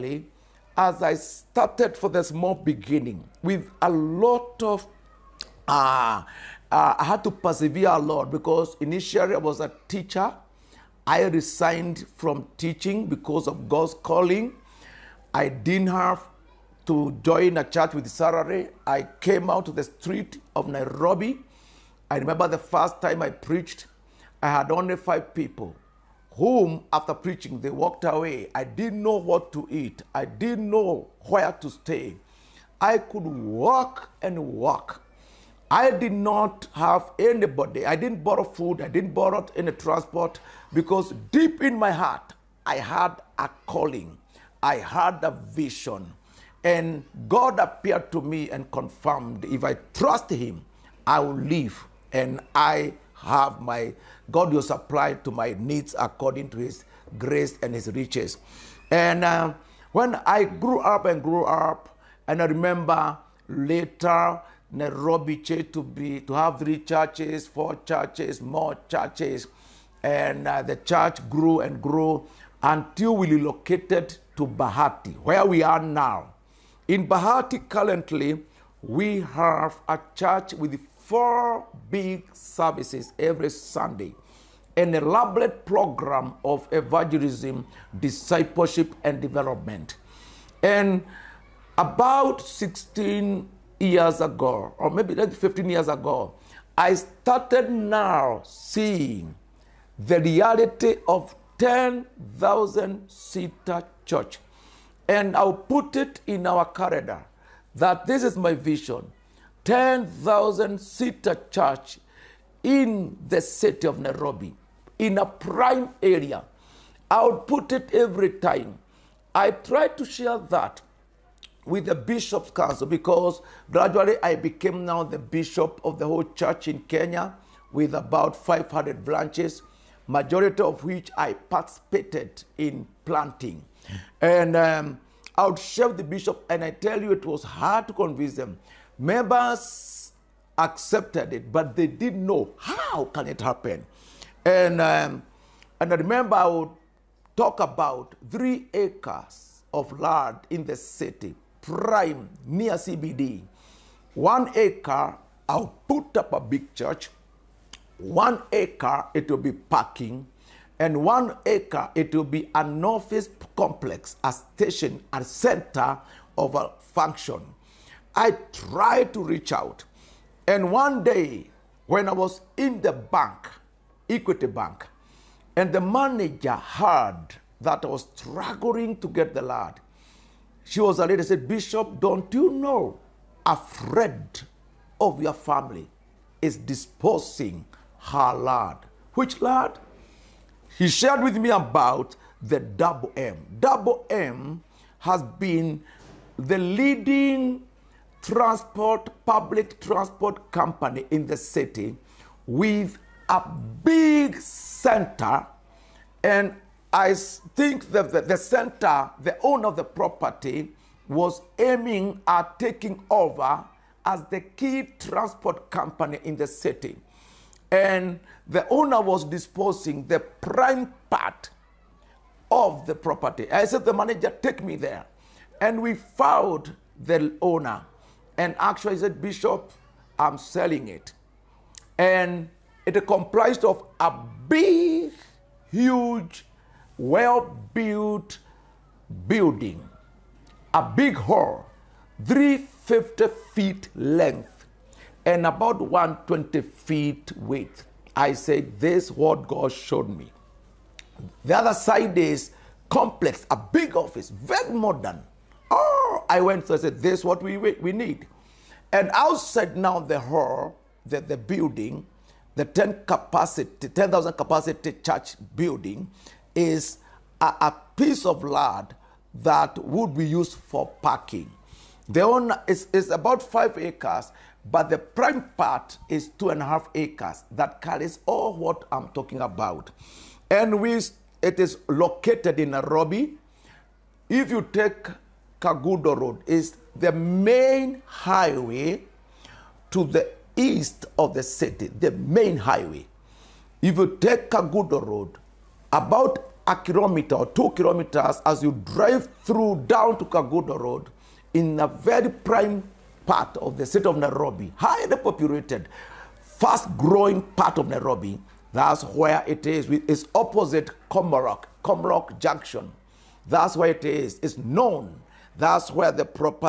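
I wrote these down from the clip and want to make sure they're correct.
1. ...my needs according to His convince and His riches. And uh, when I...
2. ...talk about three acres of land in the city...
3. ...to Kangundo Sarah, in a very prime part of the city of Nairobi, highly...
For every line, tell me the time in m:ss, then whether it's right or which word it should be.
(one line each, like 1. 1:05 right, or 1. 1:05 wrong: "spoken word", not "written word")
1. 0:55 wrong: "grace", not "convince"
2. 2:27 right
3. 5:00 wrong: "Road", not "Sarah".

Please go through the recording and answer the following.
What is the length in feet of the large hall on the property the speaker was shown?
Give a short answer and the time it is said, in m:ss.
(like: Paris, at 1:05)
350 feet, at 4:02.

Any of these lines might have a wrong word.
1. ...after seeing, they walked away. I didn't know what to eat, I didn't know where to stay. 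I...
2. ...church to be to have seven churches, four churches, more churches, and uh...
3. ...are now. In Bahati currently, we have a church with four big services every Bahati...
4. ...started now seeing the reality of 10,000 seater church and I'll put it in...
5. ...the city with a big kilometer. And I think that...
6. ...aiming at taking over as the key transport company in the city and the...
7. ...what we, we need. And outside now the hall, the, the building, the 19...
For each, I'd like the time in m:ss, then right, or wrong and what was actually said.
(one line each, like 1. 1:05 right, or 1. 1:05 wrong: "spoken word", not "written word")
1. 0:26 wrong: "preaching", not "seeing"
2. 1:05 wrong: "three", not "seven"
3. 1:15 wrong: "Sunday", not "Bahati"
4. 1:36 right
5. 3:21 wrong: "center", not "kilometer"
6. 3:31 right
7. 4:17 wrong: "10", not "19".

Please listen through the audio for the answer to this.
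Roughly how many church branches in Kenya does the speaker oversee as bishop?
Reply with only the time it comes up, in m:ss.
2:08.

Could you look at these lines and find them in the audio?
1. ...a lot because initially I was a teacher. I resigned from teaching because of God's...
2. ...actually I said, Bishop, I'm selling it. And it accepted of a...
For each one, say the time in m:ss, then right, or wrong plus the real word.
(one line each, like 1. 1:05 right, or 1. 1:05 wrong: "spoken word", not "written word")
1. 0:07 right
2. 3:48 wrong: "comprised", not "accepted".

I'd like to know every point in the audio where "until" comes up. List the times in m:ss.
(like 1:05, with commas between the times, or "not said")
1:12.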